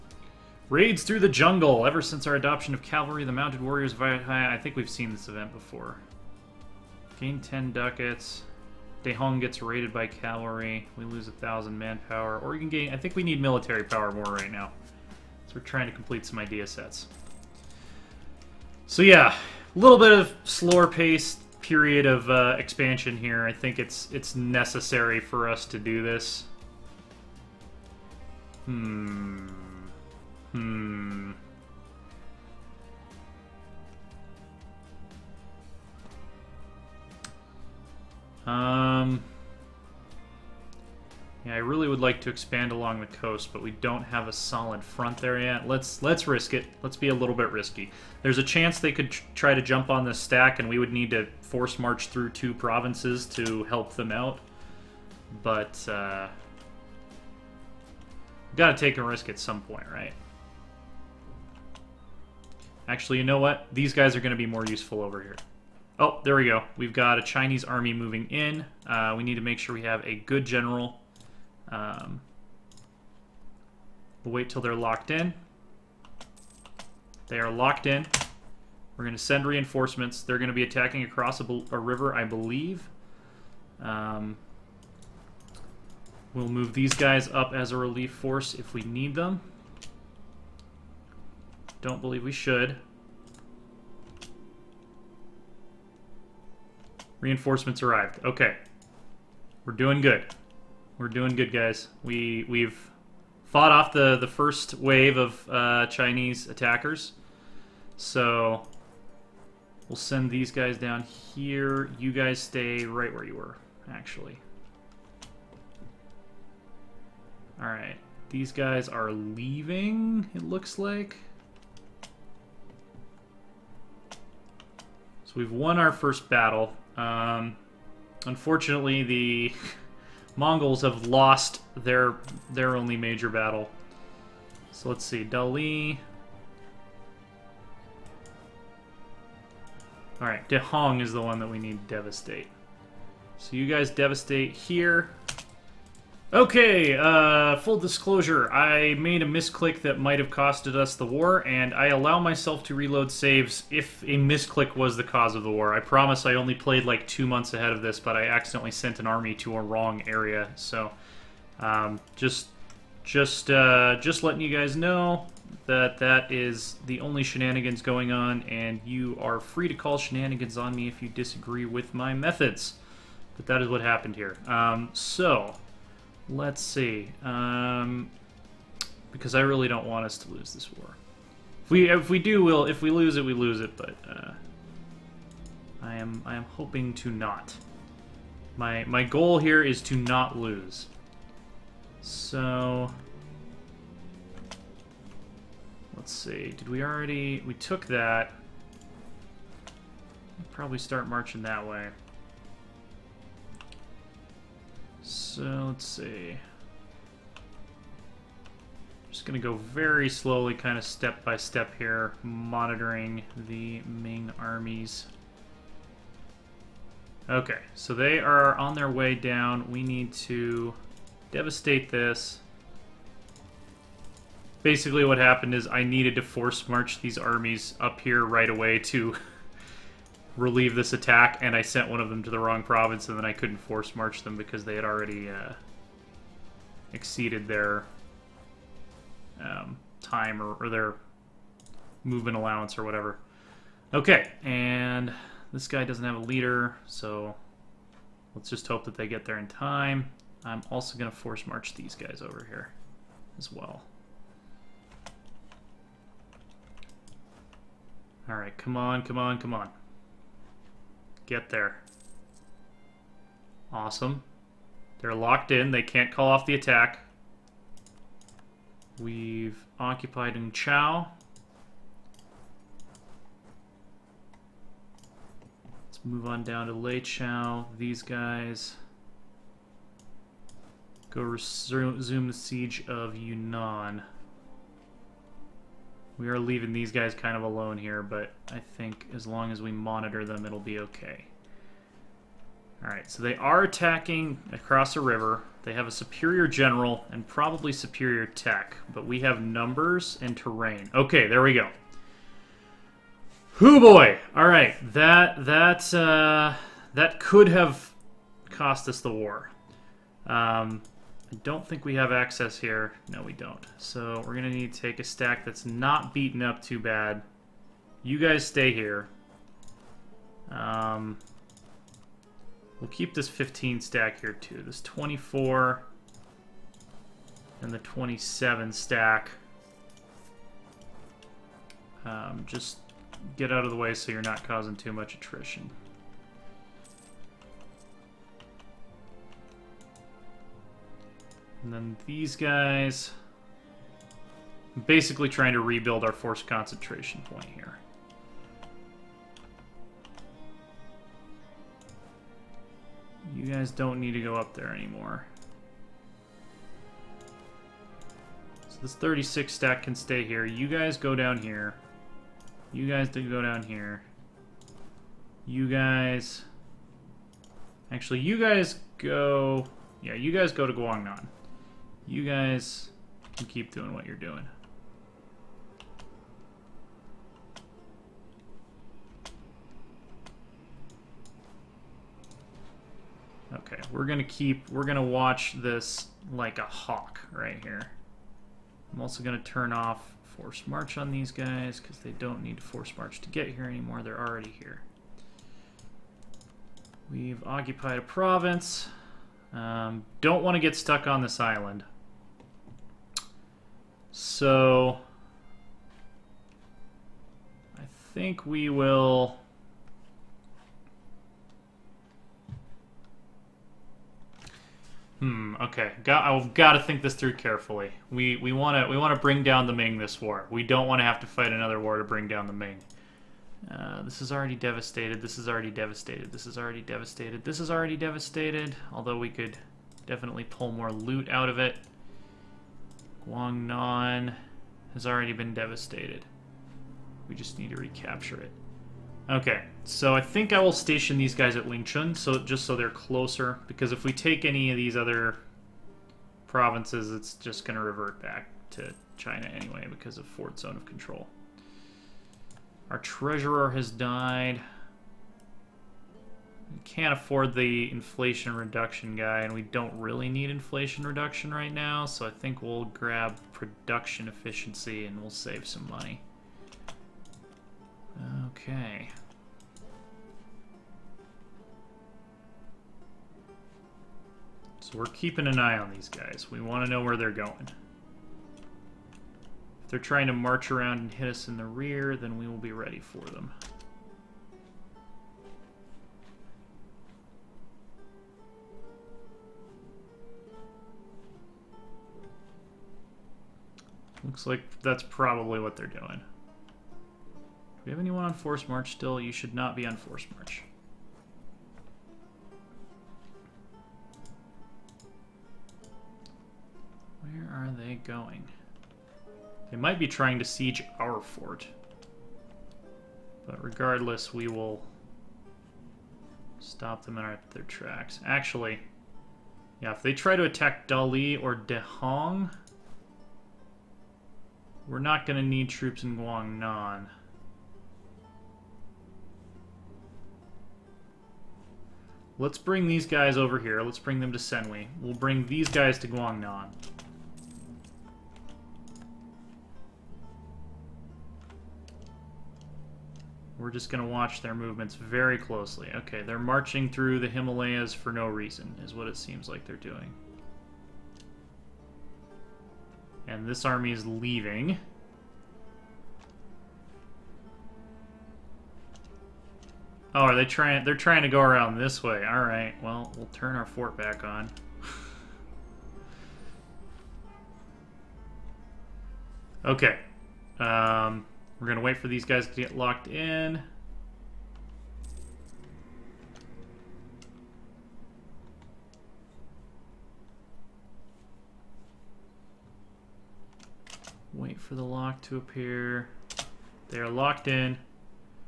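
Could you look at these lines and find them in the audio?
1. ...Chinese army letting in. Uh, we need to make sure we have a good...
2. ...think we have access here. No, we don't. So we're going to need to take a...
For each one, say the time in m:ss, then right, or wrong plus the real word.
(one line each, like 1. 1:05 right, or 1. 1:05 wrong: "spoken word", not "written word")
1. 1:07 wrong: "moving", not "letting"
2. 5:11 right.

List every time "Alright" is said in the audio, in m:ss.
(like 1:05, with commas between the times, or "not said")
4:52, 5:04.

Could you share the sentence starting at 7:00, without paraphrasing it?
We don't want to have to fight another war to bring down the Ming.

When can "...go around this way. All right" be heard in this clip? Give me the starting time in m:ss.
9:21.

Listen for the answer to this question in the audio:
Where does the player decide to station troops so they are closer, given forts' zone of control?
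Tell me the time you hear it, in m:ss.
7:21.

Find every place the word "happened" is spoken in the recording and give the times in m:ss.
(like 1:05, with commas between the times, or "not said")
2:53, 3:45.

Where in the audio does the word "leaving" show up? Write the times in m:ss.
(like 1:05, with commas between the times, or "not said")
1:59, 4:46, 9:14.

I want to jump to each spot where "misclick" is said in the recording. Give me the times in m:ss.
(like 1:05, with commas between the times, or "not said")
2:29, 2:34.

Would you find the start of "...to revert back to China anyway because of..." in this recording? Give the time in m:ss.
7:27.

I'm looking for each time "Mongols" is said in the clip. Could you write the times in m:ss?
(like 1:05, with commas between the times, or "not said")
2:10.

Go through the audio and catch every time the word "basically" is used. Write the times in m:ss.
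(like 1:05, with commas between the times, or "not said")
3:44, 5:44.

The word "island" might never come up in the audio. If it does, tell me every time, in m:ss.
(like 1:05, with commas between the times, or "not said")
6:41.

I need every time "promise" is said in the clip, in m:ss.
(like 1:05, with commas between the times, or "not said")
2:35.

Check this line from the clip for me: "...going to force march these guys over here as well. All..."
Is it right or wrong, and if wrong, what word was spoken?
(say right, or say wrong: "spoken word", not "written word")
right.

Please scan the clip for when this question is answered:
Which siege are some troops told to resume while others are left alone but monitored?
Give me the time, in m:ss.
4:43.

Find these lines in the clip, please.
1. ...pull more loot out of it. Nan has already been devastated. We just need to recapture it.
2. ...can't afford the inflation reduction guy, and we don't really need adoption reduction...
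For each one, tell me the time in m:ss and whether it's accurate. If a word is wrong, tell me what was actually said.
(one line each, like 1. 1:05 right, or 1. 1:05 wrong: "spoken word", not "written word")
1. 7:10 right
2. 7:36 wrong: "inflation", not "adoption".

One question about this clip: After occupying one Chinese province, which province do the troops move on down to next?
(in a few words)
Lei Chow.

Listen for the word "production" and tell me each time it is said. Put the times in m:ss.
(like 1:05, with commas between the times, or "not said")
7:43.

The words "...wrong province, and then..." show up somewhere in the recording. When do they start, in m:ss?
3:52.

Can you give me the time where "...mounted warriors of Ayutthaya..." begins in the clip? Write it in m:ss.
0:03.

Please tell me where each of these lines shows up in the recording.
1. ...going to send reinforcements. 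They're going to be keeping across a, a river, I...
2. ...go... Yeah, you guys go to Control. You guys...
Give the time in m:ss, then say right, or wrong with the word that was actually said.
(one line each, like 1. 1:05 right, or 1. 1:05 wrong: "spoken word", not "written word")
1. 1:19 wrong: "attacking", not "keeping"
2. 6:08 wrong: "Guangnan", not "Control".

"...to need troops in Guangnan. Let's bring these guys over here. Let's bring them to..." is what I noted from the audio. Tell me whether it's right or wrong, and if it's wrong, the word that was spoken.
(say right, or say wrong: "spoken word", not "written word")
right.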